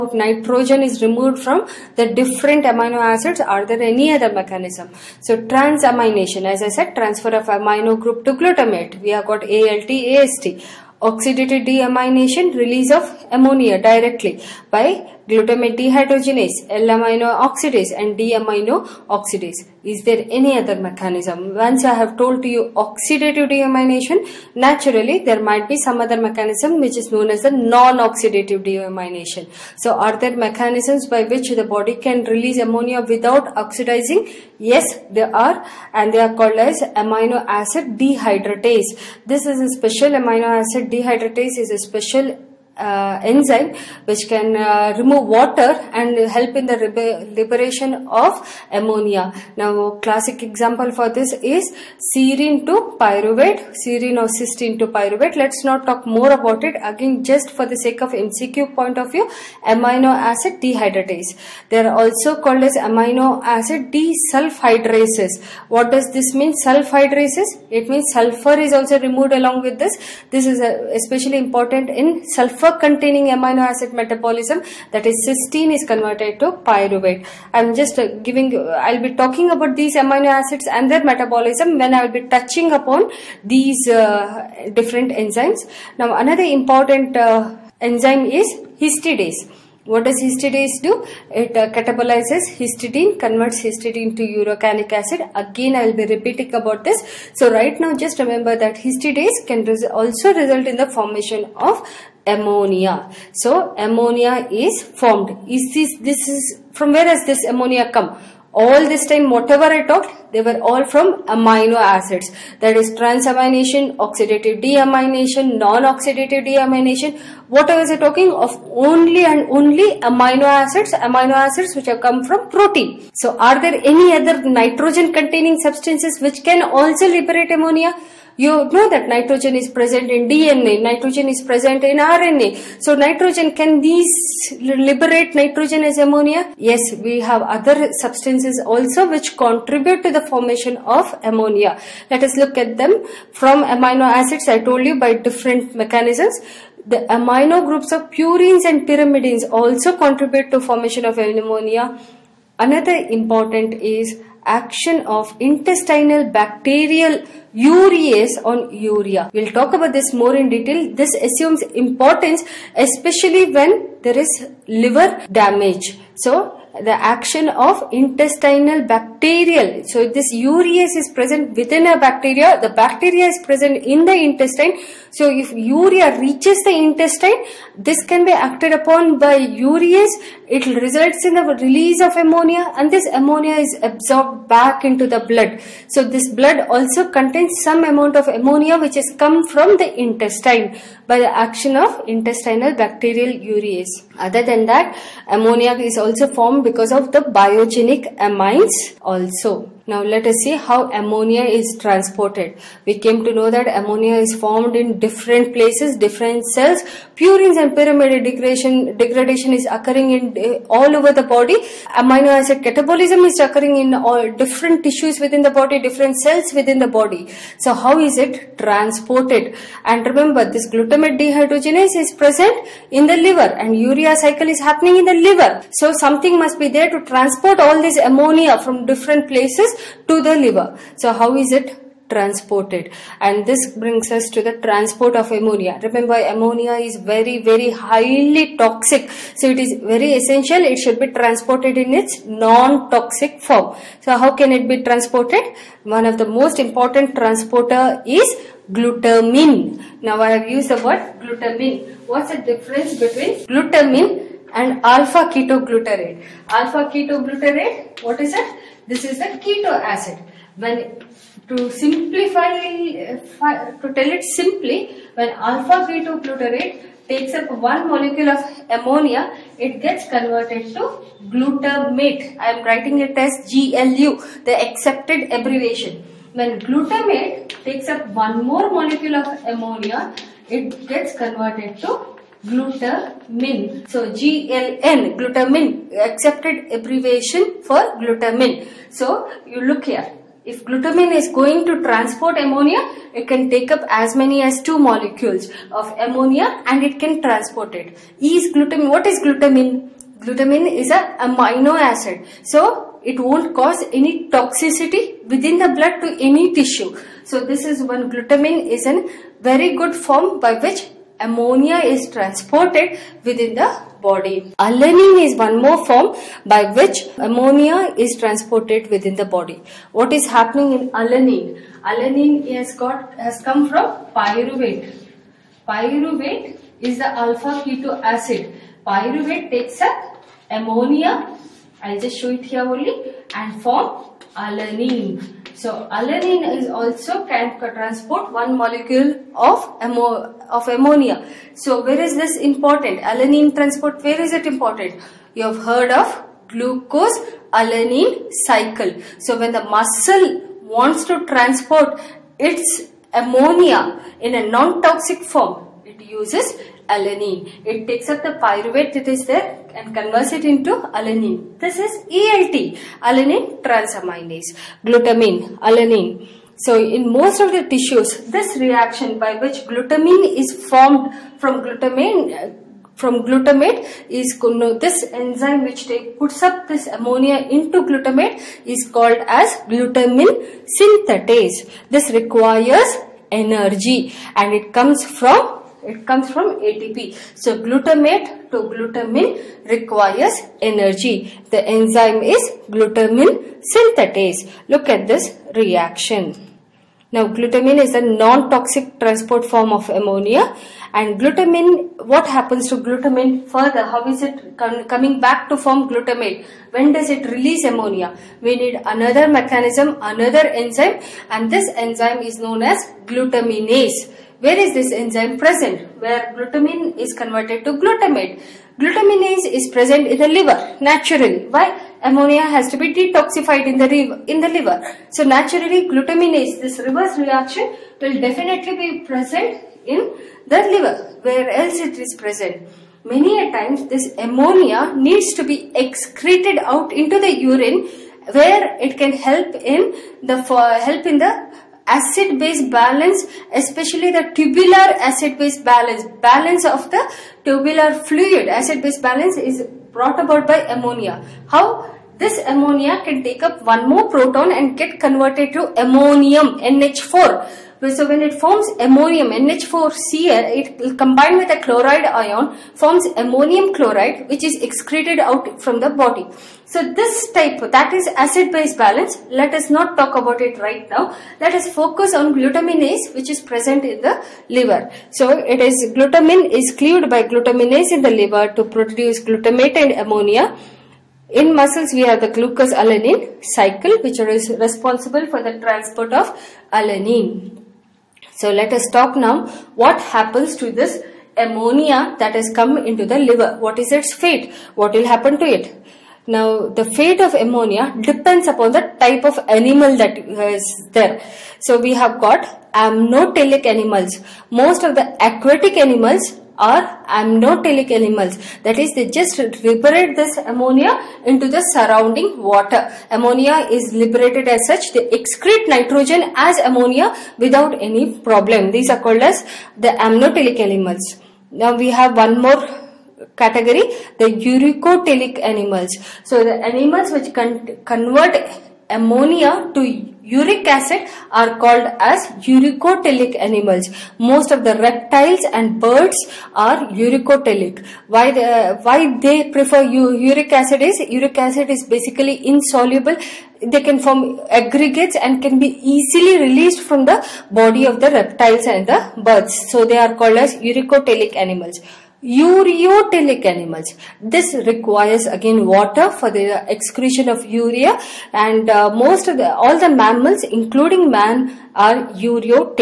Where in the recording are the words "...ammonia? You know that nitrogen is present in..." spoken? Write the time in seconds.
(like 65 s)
127 s.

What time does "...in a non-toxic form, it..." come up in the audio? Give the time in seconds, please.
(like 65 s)
354 s.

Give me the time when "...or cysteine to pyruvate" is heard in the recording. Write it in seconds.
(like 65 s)
54 s.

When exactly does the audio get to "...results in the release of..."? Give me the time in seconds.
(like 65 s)
180 s.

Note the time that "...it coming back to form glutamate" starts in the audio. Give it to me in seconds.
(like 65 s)
404 s.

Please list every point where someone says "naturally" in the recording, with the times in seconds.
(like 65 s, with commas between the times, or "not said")
24 s, 420 s, 425 s.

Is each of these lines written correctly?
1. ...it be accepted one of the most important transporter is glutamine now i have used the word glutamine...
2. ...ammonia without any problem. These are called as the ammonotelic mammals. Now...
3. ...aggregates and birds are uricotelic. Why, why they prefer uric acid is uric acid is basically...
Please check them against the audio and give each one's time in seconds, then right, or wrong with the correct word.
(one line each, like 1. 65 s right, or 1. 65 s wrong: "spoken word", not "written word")
1. 244 s wrong: "transported", not "accepted"
2. 516 s wrong: "animals", not "mammals"
3. 534 s wrong: "reptiles", not "aggregates".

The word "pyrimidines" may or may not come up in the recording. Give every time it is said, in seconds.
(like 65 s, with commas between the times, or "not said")
148 s, 207 s.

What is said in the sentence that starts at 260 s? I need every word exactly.
When to simplify, to tell it simply, when alpha keto glutarate takes up one molecule of ammonia, it gets converted to glutamate.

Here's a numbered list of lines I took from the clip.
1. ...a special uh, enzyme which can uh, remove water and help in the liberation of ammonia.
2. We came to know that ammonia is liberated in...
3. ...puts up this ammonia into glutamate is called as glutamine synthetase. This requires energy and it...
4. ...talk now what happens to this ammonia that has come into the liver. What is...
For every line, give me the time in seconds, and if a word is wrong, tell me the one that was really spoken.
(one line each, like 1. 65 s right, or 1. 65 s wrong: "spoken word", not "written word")
1. 41 s right
2. 202 s wrong: "formed", not "liberated"
3. 376 s right
4. 488 s right.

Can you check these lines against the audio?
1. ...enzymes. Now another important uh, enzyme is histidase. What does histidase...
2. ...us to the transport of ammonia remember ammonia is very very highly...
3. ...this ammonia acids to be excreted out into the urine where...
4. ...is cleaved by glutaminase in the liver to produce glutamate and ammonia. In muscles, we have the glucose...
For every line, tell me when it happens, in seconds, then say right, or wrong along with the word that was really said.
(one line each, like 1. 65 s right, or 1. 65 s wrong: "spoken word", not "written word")
1. 85 s right
2. 234 s right
3. 433 s wrong: "needs", not "acids"
4. 476 s right.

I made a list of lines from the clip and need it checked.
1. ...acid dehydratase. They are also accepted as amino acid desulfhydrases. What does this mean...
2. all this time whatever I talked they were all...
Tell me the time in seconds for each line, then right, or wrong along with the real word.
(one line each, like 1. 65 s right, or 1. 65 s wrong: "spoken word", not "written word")
1. 60 s wrong: "called", not "accepted"
2. 108 s right.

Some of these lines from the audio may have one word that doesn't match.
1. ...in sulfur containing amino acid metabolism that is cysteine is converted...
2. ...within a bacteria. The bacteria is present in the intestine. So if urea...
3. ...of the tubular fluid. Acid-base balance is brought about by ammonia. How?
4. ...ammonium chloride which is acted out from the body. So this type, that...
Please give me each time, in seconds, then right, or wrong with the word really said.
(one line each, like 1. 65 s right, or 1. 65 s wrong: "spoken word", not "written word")
1. 71 s right
2. 171 s right
3. 446 s right
4. 463 s wrong: "excreted", not "acted".